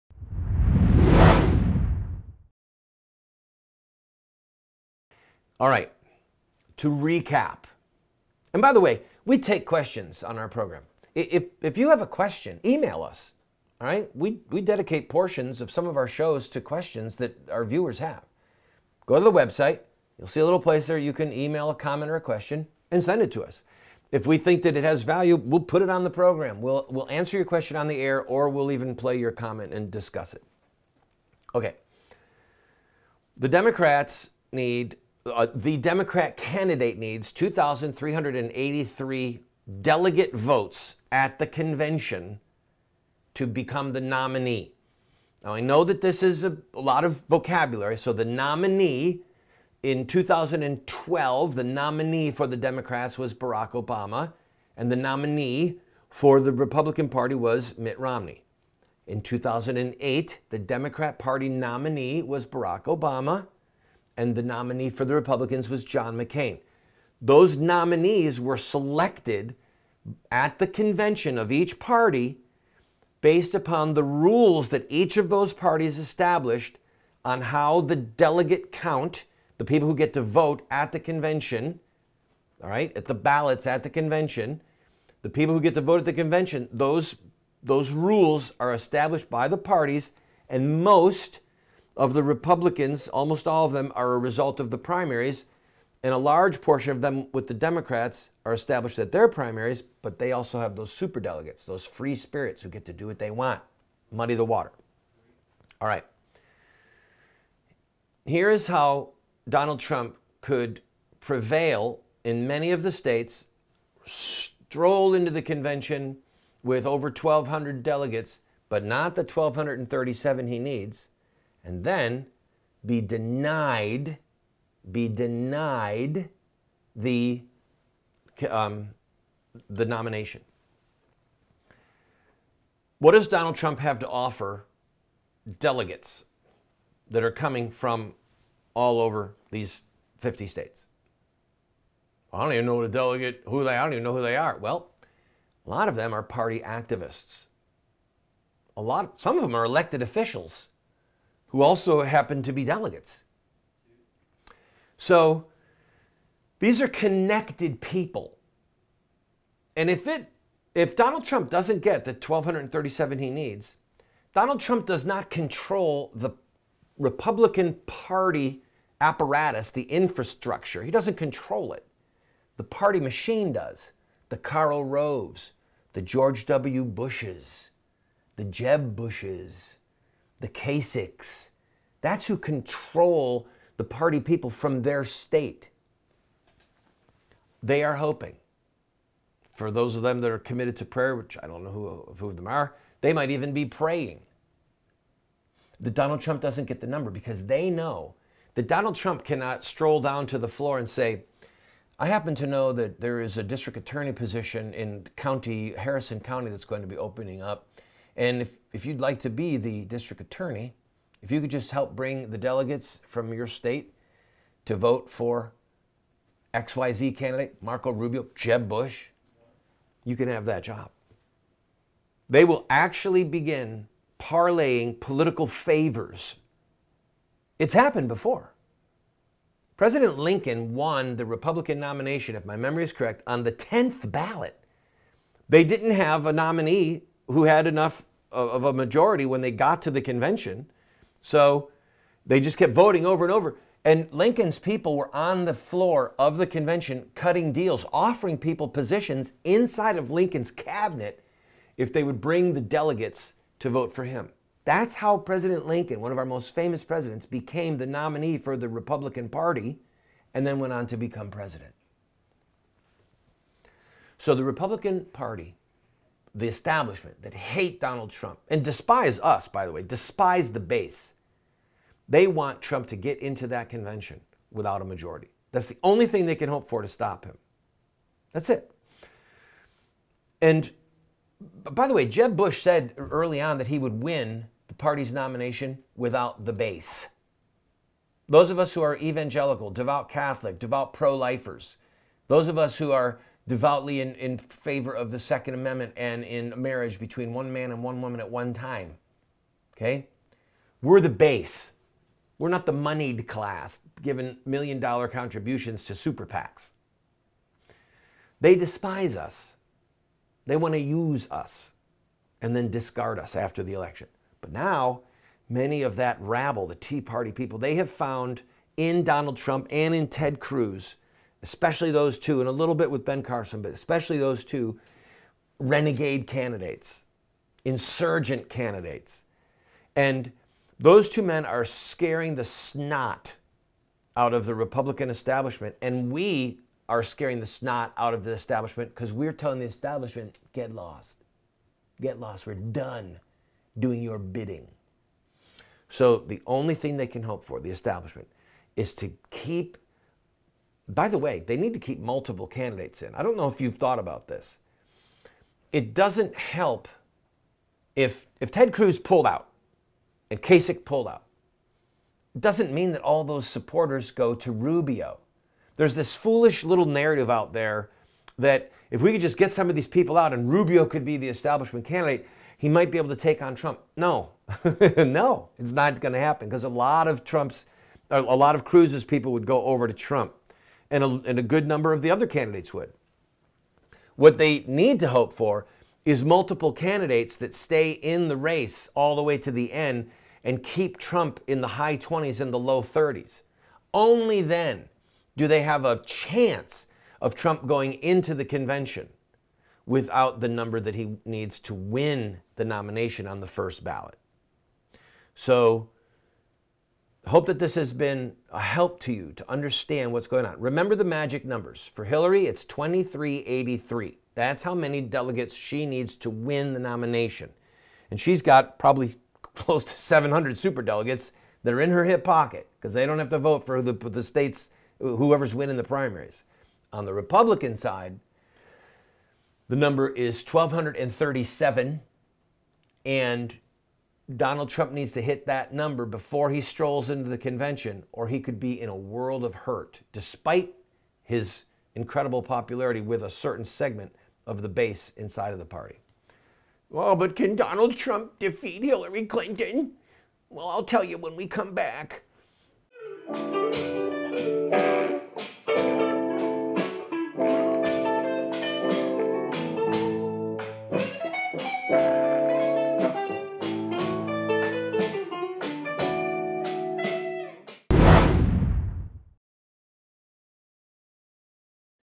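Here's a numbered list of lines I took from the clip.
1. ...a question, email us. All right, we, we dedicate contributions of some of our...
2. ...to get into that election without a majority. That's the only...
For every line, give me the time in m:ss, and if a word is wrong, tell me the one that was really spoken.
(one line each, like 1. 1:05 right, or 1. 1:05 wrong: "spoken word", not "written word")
1. 0:12 wrong: "portions", not "contributions"
2. 4:32 wrong: "convention", not "election".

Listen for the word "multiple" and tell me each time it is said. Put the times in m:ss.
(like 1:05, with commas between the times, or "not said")
5:51, 6:26.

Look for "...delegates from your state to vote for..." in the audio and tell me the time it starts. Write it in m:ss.
3:32.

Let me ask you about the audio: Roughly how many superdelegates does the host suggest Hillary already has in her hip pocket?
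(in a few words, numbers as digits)
700.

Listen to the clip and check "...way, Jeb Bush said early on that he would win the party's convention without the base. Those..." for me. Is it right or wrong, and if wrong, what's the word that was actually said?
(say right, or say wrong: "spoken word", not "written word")
wrong: "nomination", not "convention".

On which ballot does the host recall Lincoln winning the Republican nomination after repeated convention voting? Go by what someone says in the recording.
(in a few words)
10th ballot.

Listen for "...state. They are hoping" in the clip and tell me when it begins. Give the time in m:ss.
3:05.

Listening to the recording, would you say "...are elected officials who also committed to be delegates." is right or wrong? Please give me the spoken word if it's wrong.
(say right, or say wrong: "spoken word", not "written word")
wrong: "happened", not "committed".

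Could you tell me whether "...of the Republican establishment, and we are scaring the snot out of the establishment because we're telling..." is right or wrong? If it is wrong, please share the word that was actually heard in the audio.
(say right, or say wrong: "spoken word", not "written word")
right.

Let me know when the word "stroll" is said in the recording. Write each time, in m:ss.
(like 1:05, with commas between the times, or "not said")
1:54, 3:19, 7:16.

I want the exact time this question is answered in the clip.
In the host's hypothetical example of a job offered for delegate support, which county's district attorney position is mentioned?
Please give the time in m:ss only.
3:25.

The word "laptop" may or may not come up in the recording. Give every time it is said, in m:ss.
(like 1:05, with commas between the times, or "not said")
not said.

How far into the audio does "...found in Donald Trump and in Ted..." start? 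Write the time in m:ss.
5:17.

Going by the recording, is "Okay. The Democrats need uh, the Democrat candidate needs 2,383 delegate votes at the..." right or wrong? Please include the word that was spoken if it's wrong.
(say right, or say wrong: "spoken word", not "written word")
right.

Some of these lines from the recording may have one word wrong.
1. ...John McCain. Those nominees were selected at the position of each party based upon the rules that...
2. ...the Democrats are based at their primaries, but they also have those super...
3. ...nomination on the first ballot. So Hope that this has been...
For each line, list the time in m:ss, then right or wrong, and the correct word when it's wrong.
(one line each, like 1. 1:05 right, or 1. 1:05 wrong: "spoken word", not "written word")
1. 1:05 wrong: "convention", not "position"
2. 1:37 wrong: "established", not "based"
3. 6:42 right.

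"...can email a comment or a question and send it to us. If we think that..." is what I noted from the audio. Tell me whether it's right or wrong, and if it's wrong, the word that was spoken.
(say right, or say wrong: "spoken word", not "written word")
right.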